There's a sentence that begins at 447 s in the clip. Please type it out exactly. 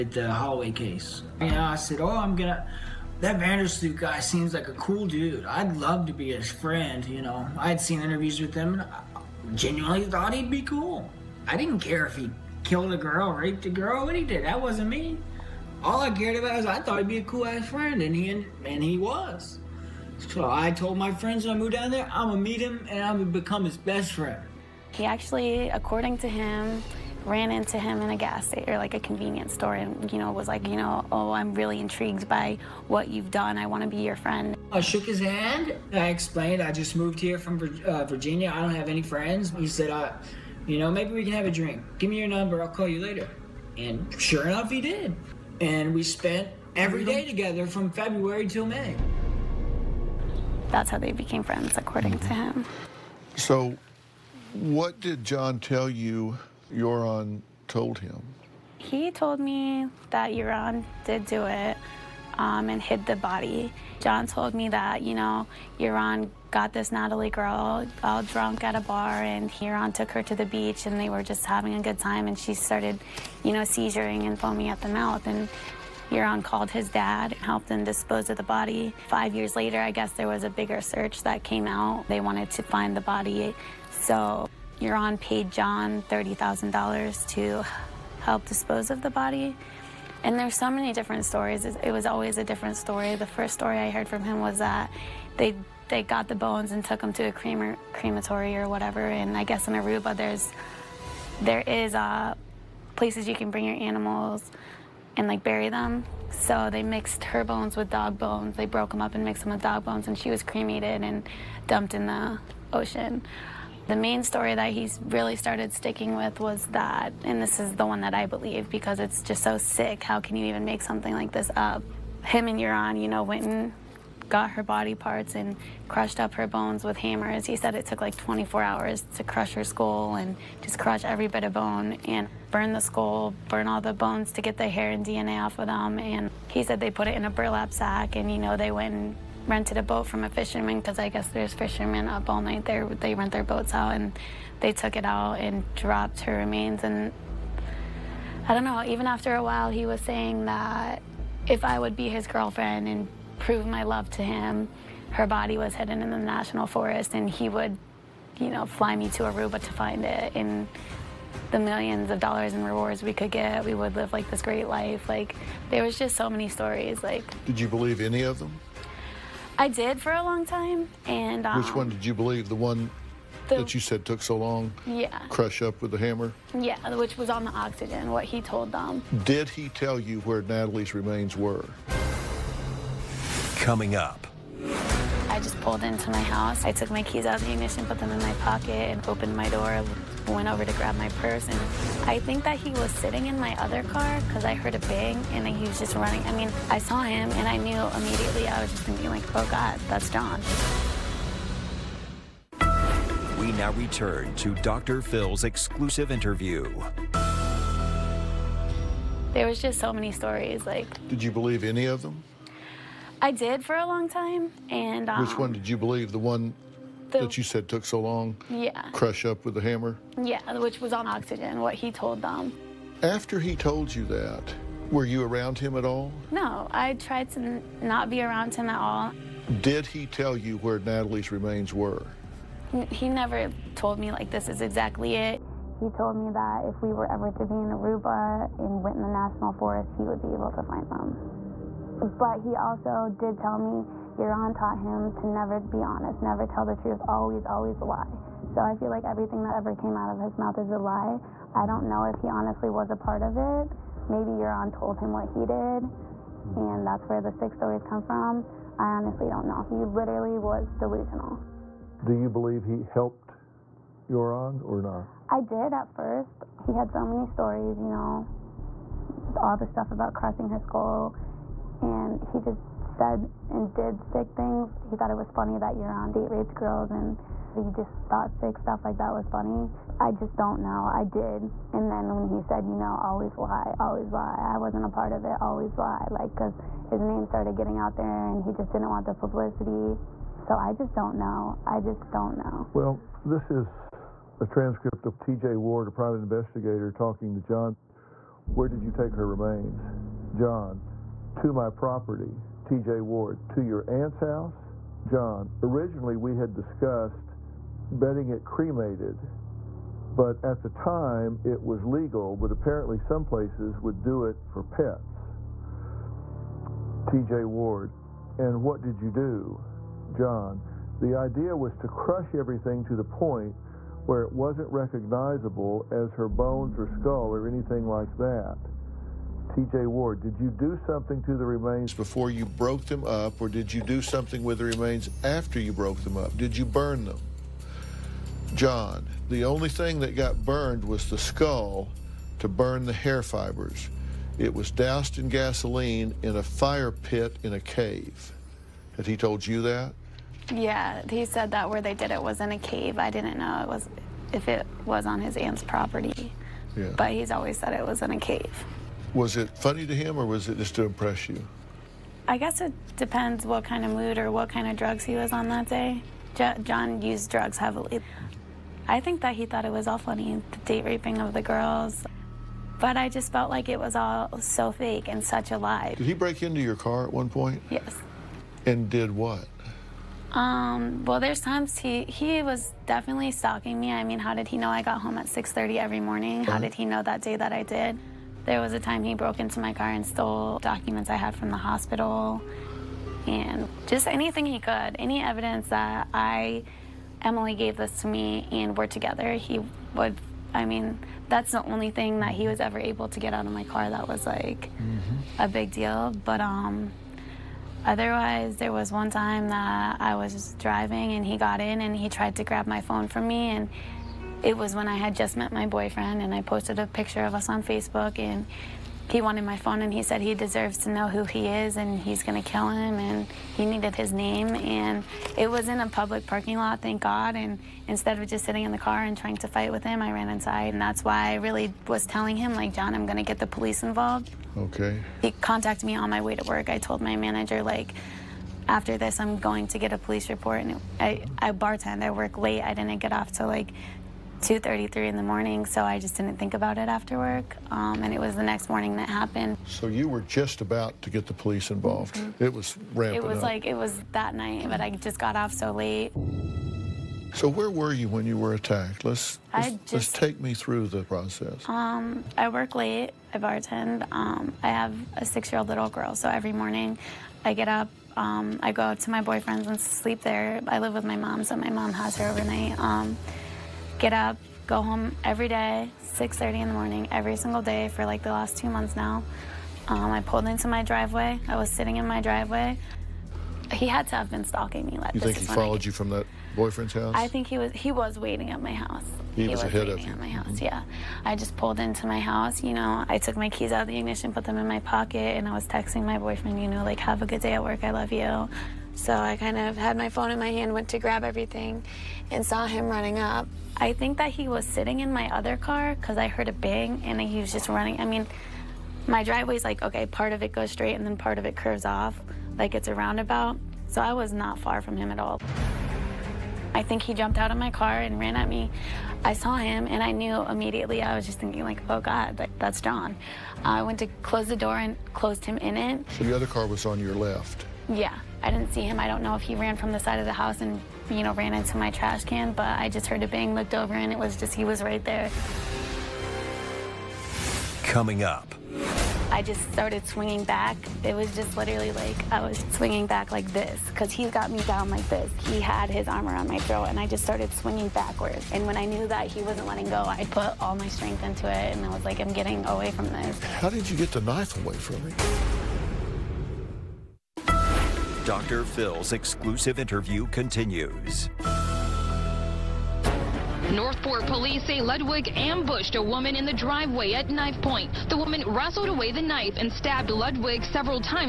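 Um, and it was the next morning that happened.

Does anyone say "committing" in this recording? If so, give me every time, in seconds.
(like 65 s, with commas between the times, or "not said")
not said.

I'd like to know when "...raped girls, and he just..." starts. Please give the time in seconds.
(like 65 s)
276 s.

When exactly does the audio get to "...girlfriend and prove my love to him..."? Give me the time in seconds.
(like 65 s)
152 s.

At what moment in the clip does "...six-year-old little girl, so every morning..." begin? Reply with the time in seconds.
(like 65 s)
465 s.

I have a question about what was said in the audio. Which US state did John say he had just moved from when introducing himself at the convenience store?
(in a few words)
Virginia.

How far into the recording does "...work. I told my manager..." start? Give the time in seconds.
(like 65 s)
436 s.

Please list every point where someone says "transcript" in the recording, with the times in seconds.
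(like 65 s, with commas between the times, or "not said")
294 s.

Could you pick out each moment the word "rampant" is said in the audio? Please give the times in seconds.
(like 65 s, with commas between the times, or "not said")
452 s.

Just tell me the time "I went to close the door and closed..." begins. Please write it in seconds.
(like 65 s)
523 s.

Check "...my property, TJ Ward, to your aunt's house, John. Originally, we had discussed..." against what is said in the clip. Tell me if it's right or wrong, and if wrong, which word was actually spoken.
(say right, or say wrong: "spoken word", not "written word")
right.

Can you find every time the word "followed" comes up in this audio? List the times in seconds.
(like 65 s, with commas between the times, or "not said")
485 s.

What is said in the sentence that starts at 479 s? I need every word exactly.
Um, I pulled into my driveway.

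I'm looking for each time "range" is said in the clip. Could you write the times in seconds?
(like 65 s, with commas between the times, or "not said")
not said.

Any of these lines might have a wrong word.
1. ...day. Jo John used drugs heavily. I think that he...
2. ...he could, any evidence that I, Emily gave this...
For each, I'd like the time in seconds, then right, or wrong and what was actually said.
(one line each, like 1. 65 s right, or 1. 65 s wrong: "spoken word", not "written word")
1. 365 s right
2. 394 s right.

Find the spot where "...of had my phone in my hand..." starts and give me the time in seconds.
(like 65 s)
499 s.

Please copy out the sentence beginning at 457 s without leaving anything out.
So where were you when you were attacked?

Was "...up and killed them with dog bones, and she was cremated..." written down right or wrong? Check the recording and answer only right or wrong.
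wrong.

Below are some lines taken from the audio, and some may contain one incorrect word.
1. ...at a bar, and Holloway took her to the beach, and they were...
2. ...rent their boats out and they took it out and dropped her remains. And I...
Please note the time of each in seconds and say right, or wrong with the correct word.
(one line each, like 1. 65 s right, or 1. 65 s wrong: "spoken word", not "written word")
1. 68 s wrong: "Joran", not "Holloway"
2. 143 s right.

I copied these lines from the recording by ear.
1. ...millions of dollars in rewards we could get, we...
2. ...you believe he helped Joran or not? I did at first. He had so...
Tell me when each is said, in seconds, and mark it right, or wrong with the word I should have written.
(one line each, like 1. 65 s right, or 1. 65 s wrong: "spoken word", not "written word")
1. 161 s right
2. 262 s right.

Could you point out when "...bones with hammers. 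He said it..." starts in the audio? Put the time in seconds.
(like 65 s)
126 s.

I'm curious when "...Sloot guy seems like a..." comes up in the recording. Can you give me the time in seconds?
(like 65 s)
3 s.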